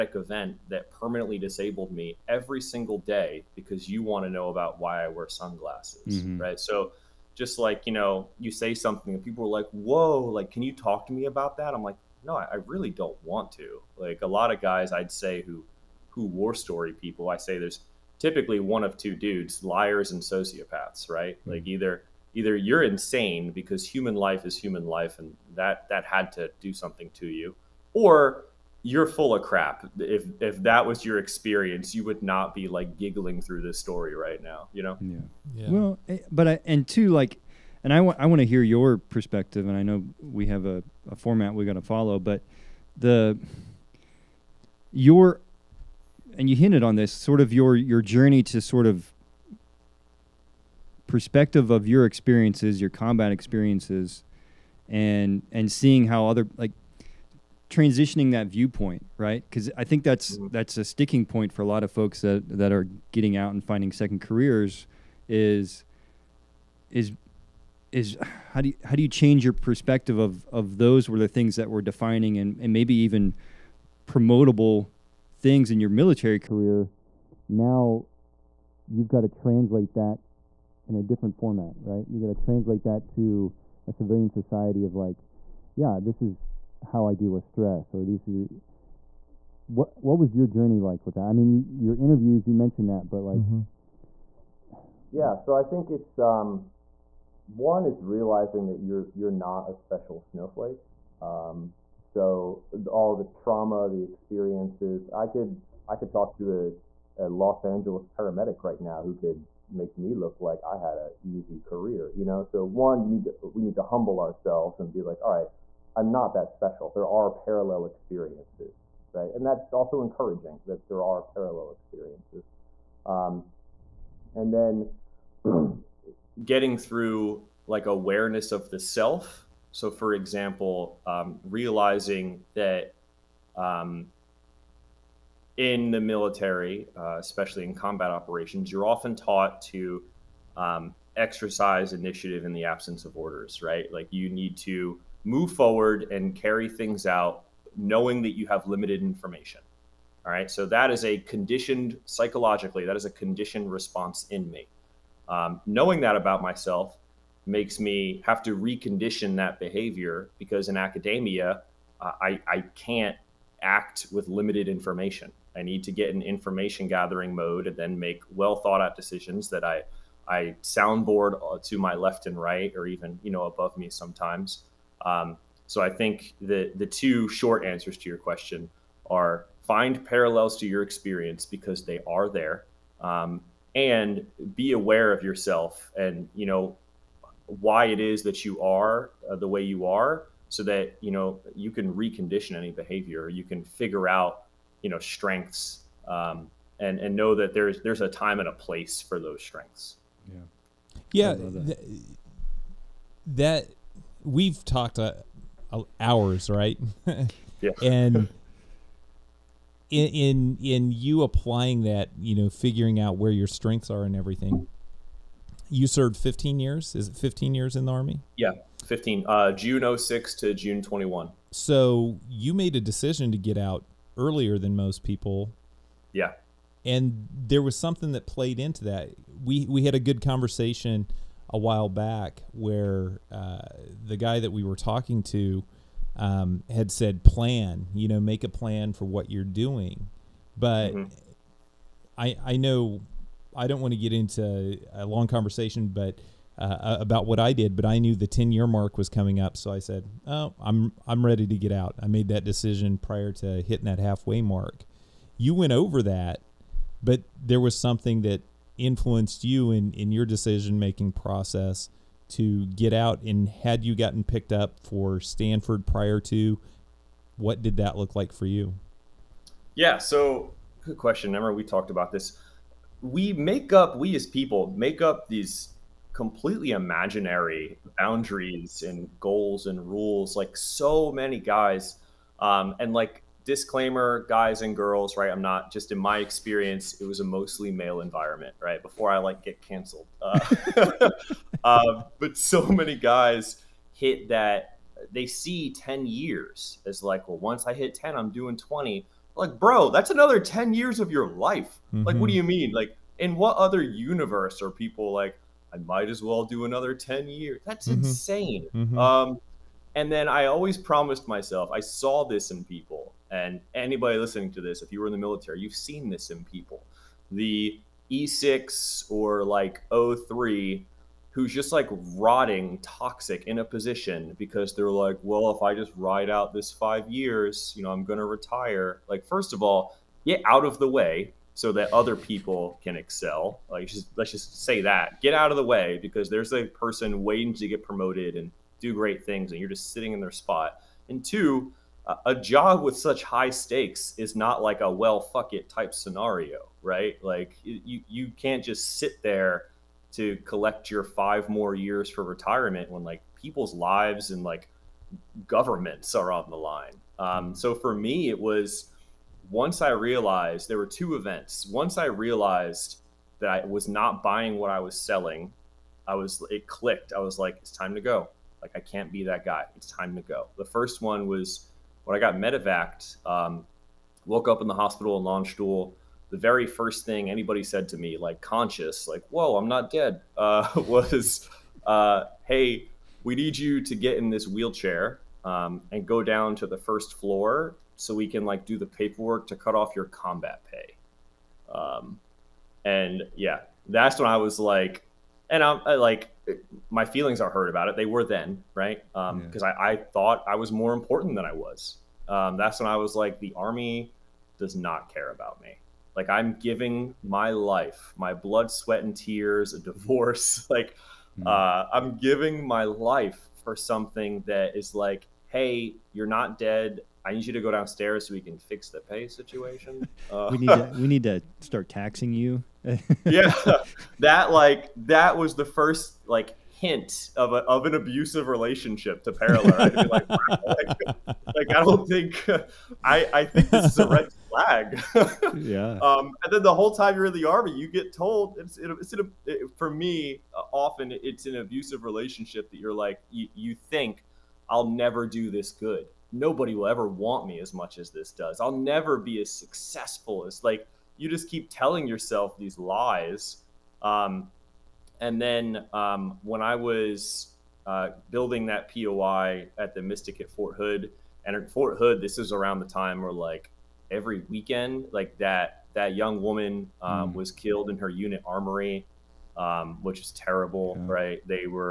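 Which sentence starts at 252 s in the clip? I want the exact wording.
I made that decision prior to hitting that halfway mark.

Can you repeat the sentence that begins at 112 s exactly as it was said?
So one, you need to we need to humble ourselves and be like, all right I'm not that special.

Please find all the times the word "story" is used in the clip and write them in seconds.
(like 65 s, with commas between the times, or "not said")
16 s, 33 s.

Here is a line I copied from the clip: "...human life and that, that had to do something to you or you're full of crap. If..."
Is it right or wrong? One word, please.
right.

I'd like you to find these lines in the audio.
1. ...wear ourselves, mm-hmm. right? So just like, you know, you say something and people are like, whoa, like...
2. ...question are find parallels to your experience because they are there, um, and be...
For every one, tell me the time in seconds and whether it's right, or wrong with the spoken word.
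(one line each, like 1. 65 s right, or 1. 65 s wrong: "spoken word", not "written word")
1. 5 s wrong: "sunglasses", not "ourselves"
2. 178 s right.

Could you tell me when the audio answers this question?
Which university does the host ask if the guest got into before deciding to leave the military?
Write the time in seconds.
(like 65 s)
265 s.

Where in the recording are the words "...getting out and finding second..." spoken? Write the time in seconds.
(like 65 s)
63 s.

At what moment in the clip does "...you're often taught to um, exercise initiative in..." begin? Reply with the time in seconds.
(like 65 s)
138 s.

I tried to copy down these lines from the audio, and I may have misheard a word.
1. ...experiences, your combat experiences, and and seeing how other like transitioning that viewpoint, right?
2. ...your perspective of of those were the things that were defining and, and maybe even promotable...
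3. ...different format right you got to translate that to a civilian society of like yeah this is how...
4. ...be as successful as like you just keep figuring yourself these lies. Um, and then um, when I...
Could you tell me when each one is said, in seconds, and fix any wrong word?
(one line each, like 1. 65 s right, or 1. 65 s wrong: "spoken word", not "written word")
1. 52 s right
2. 69 s right
3. 81 s right
4. 449 s wrong: "telling", not "figuring".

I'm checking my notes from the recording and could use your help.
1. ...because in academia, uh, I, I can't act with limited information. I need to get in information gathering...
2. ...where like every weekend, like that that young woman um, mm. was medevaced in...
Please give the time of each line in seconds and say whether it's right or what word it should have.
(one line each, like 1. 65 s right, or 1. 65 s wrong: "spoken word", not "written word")
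1. 160 s right
2. 463 s wrong: "killed", not "medevaced".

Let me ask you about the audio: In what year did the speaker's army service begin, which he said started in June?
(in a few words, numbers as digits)
2006.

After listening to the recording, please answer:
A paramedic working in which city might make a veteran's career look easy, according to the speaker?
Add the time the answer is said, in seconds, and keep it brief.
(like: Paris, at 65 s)
Los Angeles, at 107 s.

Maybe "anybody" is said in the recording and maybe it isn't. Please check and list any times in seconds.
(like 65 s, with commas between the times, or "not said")
313 s, 377 s.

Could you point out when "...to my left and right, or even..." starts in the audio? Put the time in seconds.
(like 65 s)
171 s.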